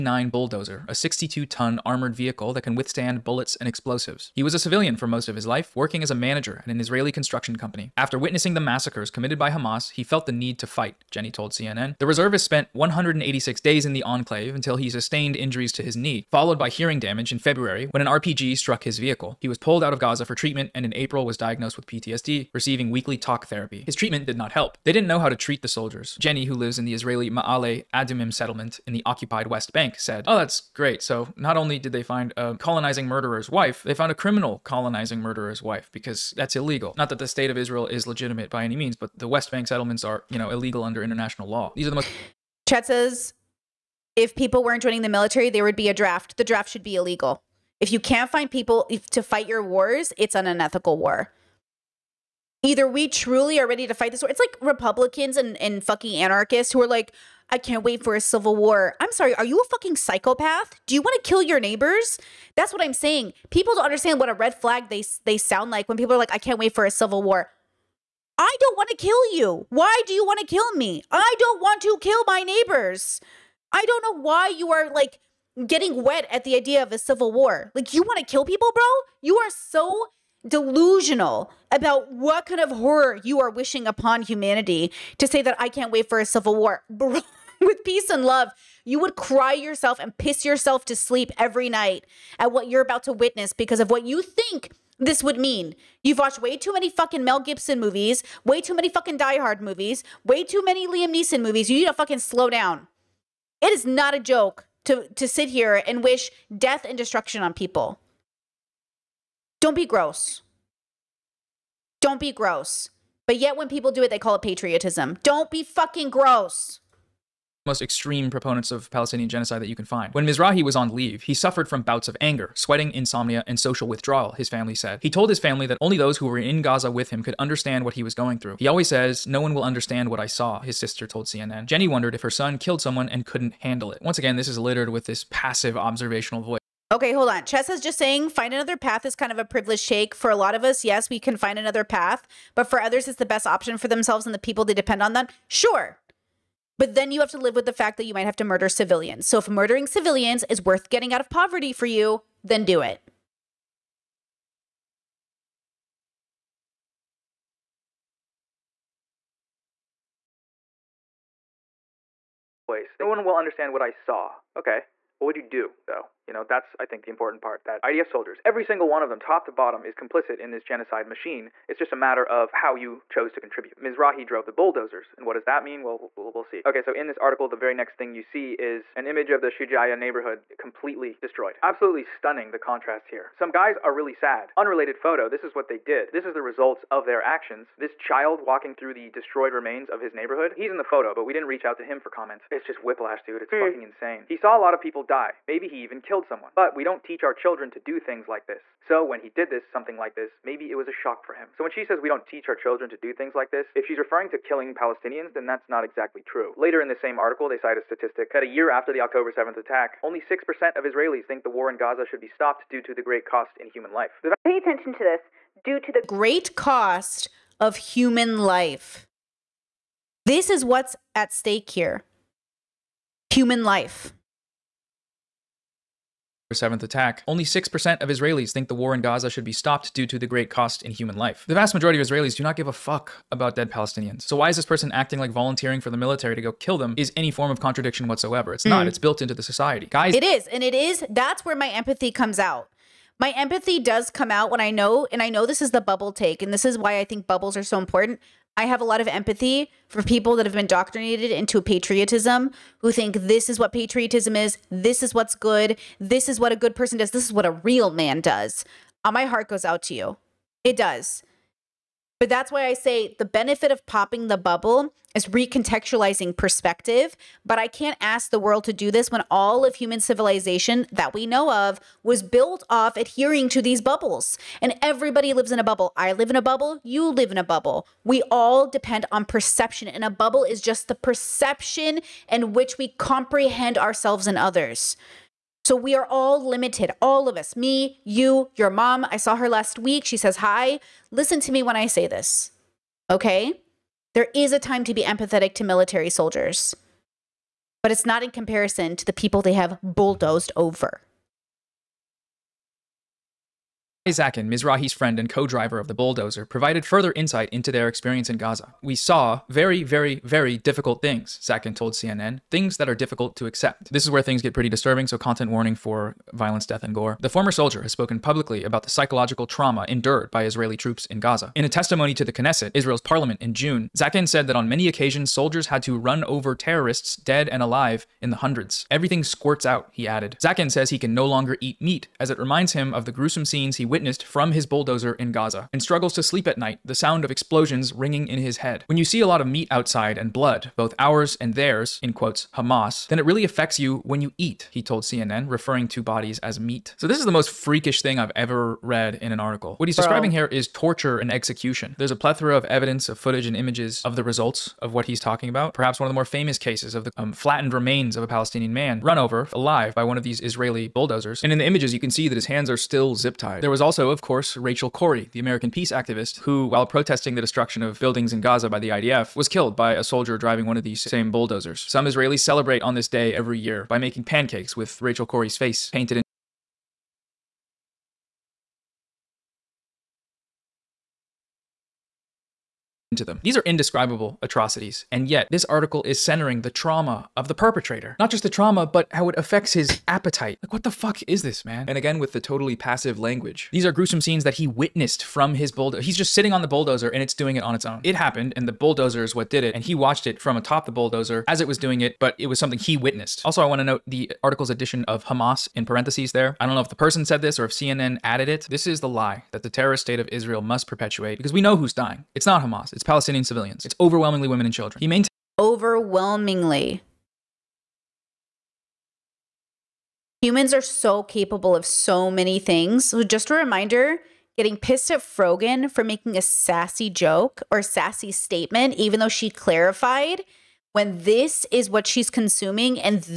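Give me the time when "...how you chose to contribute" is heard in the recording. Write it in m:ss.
2:52.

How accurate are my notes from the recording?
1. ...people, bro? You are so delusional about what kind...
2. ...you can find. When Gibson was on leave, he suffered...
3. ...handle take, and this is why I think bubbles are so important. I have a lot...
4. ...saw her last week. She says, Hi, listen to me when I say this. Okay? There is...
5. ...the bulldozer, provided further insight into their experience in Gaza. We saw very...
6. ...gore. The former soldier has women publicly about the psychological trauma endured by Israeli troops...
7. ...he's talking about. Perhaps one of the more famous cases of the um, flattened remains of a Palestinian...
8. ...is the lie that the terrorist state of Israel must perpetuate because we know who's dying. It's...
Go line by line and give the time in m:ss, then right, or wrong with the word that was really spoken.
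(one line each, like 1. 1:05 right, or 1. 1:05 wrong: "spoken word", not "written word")
1. 1:18 right
2. 1:59 wrong: "Mizrahi", not "Gibson"
3. 4:05 wrong: "bubble", not "handle"
4. 4:49 right
5. 5:05 right
6. 5:16 wrong: "spoken", not "women"
7. 5:55 right
8. 6:48 right.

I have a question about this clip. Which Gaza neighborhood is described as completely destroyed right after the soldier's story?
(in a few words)
Shujaya.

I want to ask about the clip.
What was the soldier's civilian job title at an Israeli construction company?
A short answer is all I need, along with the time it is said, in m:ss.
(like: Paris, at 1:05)
Manager, at 0:06.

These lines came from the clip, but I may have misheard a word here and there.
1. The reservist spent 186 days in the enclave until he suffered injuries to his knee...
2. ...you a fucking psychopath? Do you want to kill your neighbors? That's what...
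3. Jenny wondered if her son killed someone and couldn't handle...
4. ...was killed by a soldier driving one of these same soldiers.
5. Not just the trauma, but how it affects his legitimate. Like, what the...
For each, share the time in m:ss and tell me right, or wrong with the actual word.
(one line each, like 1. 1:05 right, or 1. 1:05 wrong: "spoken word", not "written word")
1. 0:11 wrong: "sustained", not "suffered"
2. 0:59 right
3. 2:11 right
4. 6:09 wrong: "bulldozers", not "soldiers"
5. 6:28 wrong: "appetite", not "legitimate".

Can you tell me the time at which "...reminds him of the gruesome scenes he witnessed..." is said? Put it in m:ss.
5:32.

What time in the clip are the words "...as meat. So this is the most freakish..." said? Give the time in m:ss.
5:46.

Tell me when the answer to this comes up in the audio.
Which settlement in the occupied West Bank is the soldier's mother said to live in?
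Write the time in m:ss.
0:27.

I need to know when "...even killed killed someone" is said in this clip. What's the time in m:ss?
3:15.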